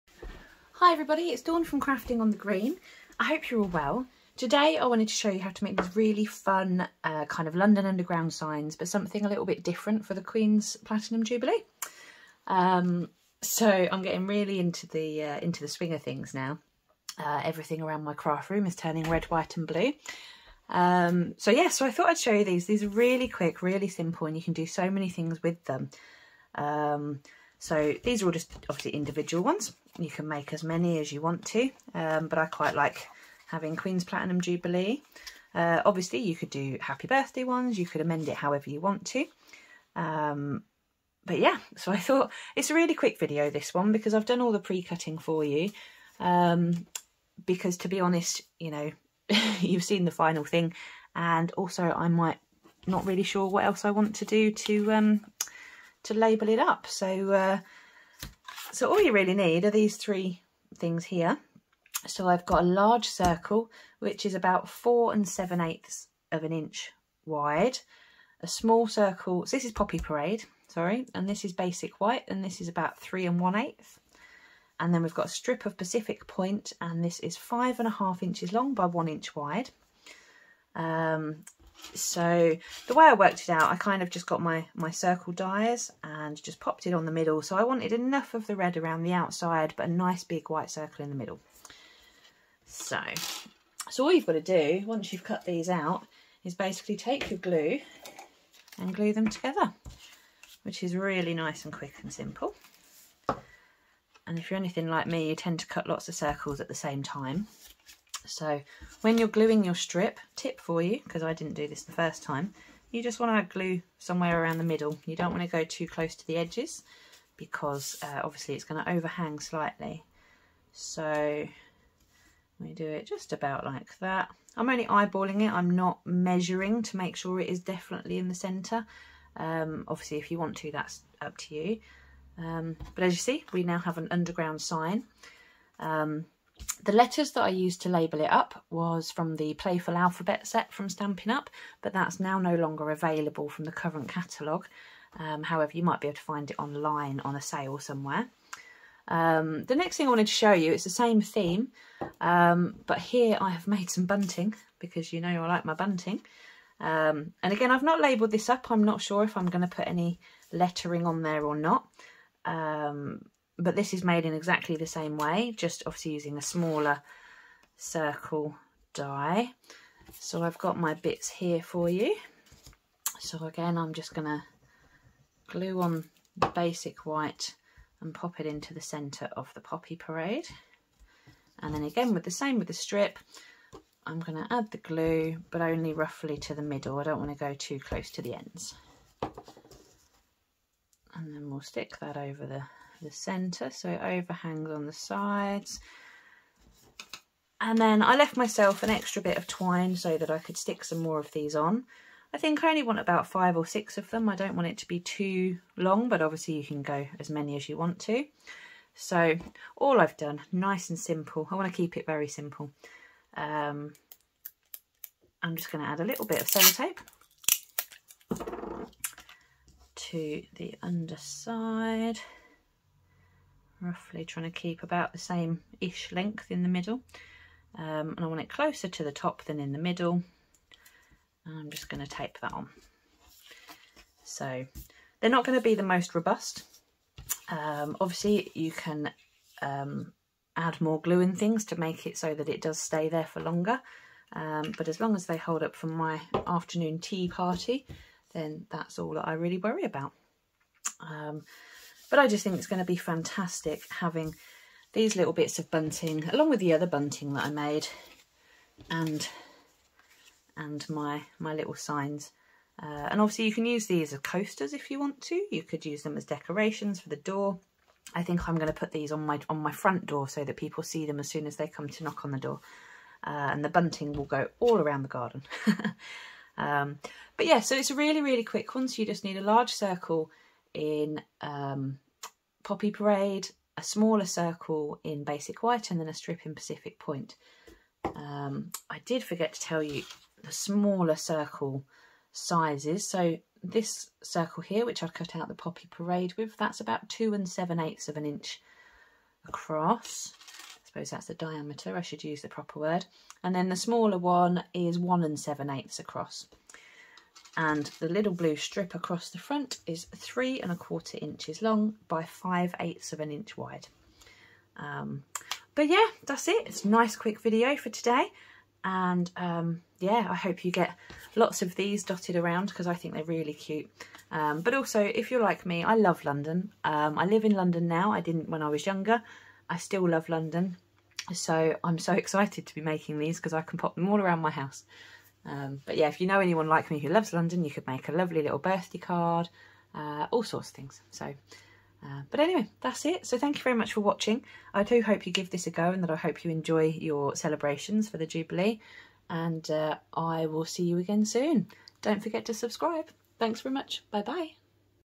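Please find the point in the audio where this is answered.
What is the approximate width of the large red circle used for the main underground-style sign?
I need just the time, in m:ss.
1:04.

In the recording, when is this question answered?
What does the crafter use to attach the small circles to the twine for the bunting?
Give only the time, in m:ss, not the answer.
3:36.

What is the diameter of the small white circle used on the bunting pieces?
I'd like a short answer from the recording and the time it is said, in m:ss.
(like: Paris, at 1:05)
1 7/8 inches, at 5:04.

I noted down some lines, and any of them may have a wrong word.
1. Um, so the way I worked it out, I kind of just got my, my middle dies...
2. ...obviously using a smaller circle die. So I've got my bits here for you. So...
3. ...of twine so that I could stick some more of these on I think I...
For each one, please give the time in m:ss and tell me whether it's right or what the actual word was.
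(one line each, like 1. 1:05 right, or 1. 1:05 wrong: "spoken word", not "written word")
1. 1:20 wrong: "circle", not "middle"
2. 2:45 right
3. 3:19 right.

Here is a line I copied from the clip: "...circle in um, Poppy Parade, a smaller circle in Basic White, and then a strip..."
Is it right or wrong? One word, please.
right.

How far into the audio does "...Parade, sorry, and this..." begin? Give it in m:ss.
1:09.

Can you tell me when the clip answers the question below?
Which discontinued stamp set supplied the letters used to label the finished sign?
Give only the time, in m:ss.
2:19.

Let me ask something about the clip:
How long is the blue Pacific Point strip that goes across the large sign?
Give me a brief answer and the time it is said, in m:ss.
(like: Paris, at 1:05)
5.5 inches, at 1:17.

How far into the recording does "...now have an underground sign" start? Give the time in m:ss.
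2:13.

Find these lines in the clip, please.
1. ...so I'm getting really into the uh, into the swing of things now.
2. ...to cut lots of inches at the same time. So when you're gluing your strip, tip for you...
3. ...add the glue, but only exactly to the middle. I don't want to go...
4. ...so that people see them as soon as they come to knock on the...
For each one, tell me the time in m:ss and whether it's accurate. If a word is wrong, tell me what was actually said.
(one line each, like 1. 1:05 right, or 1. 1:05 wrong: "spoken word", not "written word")
1. 0:13 right
2. 1:45 wrong: "circles", not "inches"
3. 3:04 wrong: "roughly", not "exactly"
4. 4:30 right.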